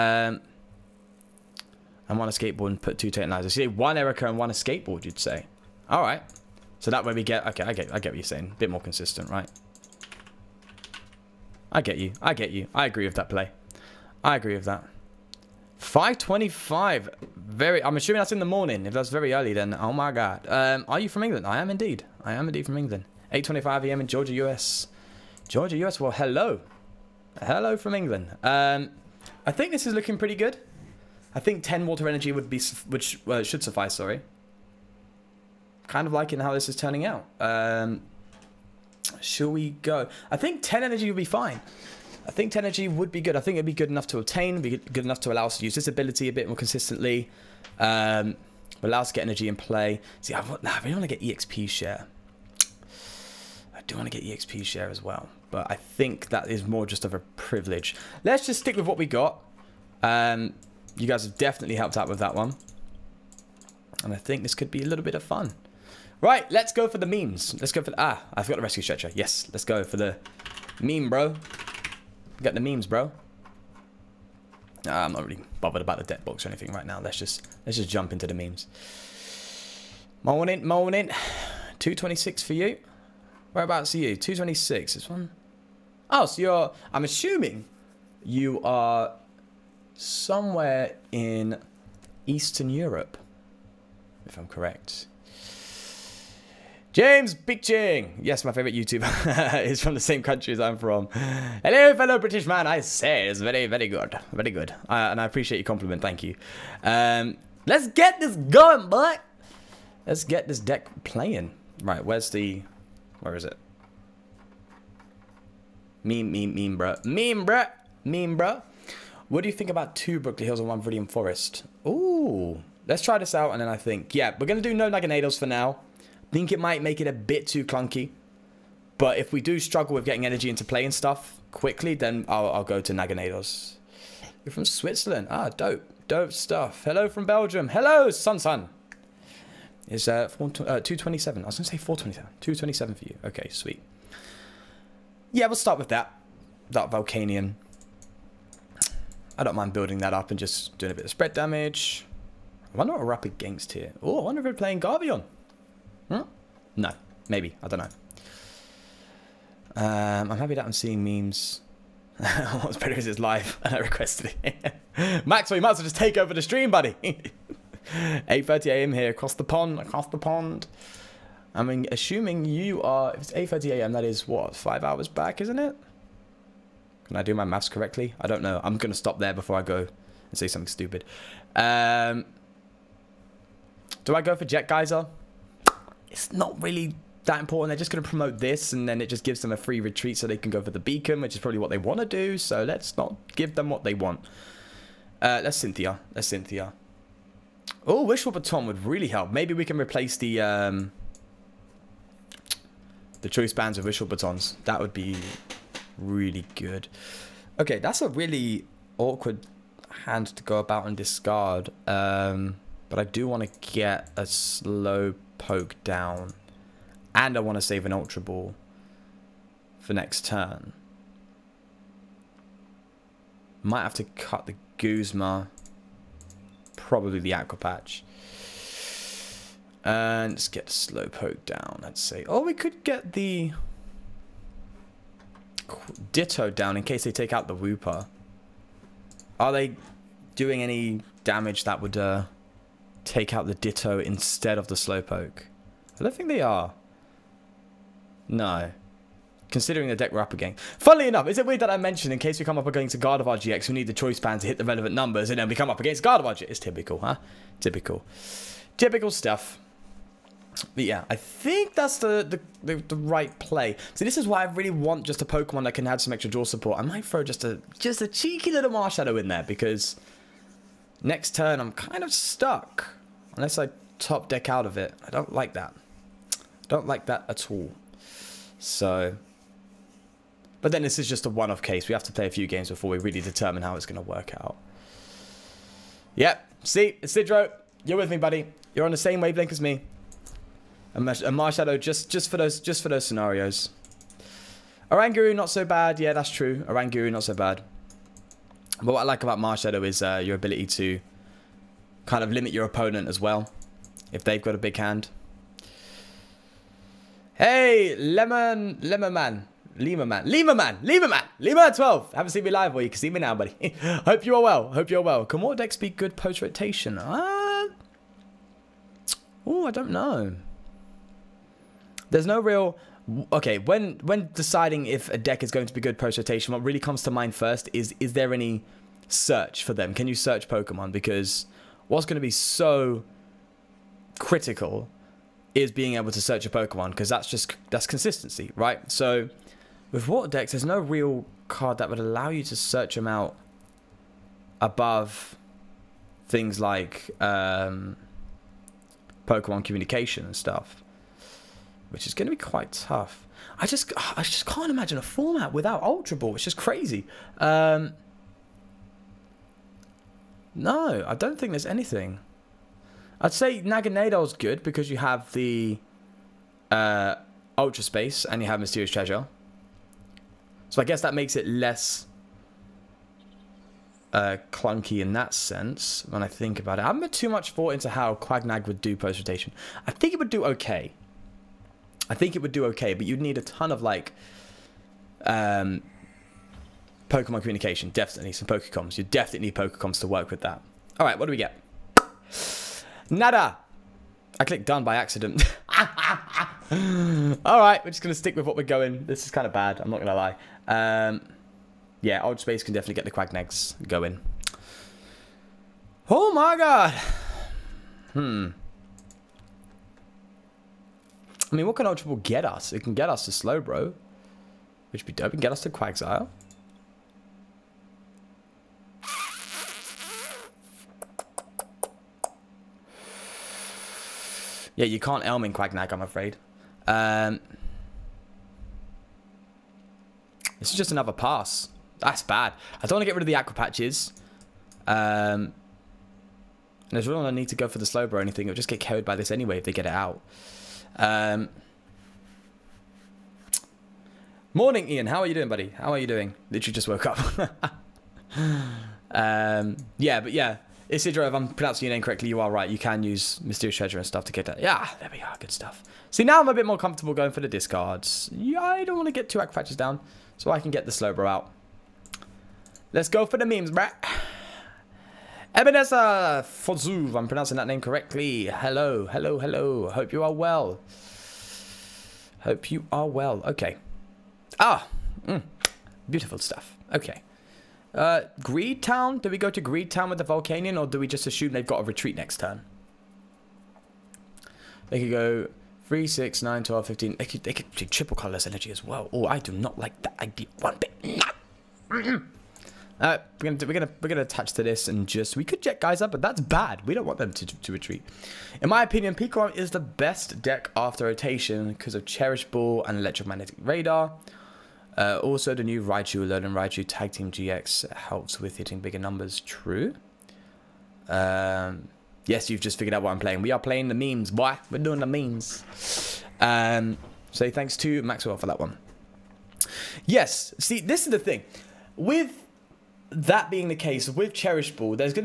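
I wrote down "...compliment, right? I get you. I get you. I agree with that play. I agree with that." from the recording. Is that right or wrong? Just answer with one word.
wrong.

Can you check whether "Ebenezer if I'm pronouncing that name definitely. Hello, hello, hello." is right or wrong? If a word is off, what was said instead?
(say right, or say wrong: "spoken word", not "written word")
wrong: "correctly", not "definitely".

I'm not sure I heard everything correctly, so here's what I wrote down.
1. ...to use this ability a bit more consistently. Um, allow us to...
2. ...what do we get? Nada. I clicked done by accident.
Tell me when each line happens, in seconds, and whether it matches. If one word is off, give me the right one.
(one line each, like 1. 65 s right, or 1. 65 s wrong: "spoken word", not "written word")
1. 45 s right
2. 391 s right.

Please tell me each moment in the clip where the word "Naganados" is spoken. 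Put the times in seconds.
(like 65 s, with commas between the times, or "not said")
124 s, 132 s, 363 s.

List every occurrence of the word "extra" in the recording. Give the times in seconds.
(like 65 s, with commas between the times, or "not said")
266 s.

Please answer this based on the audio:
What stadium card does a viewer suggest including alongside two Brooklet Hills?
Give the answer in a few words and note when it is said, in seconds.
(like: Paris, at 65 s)
Viridian Forest, at 120 s.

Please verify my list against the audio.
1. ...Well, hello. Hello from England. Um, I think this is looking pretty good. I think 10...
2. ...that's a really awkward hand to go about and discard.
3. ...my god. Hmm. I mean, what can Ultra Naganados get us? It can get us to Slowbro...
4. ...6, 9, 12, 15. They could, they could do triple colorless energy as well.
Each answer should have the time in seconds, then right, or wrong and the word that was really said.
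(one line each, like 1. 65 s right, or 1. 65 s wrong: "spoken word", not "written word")
1. 25 s right
2. 207 s right
3. 406 s wrong: "Ball", not "Naganados"
4. 486 s right.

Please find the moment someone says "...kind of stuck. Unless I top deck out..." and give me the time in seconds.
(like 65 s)
271 s.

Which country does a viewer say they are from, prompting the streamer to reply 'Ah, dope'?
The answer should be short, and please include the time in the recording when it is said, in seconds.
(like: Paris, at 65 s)
Switzerland, at 134 s.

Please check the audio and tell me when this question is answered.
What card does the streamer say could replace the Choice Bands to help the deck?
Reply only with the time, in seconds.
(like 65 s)
203 s.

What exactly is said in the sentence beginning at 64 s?
And I think this could be a little bit of fun.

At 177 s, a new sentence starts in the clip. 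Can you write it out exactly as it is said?
Can I do my maths correctly?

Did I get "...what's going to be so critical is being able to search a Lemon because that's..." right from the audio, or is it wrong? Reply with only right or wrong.
wrong.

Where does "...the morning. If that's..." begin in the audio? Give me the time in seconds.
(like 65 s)
18 s.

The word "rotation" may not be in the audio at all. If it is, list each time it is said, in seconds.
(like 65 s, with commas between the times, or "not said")
316 s, 326 s, 379 s, 501 s.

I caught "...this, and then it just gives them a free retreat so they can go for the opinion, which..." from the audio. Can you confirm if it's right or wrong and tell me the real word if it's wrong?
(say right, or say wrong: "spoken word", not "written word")
wrong: "beacon", not "opinion".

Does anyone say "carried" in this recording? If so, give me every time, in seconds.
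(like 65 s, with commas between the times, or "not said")
438 s.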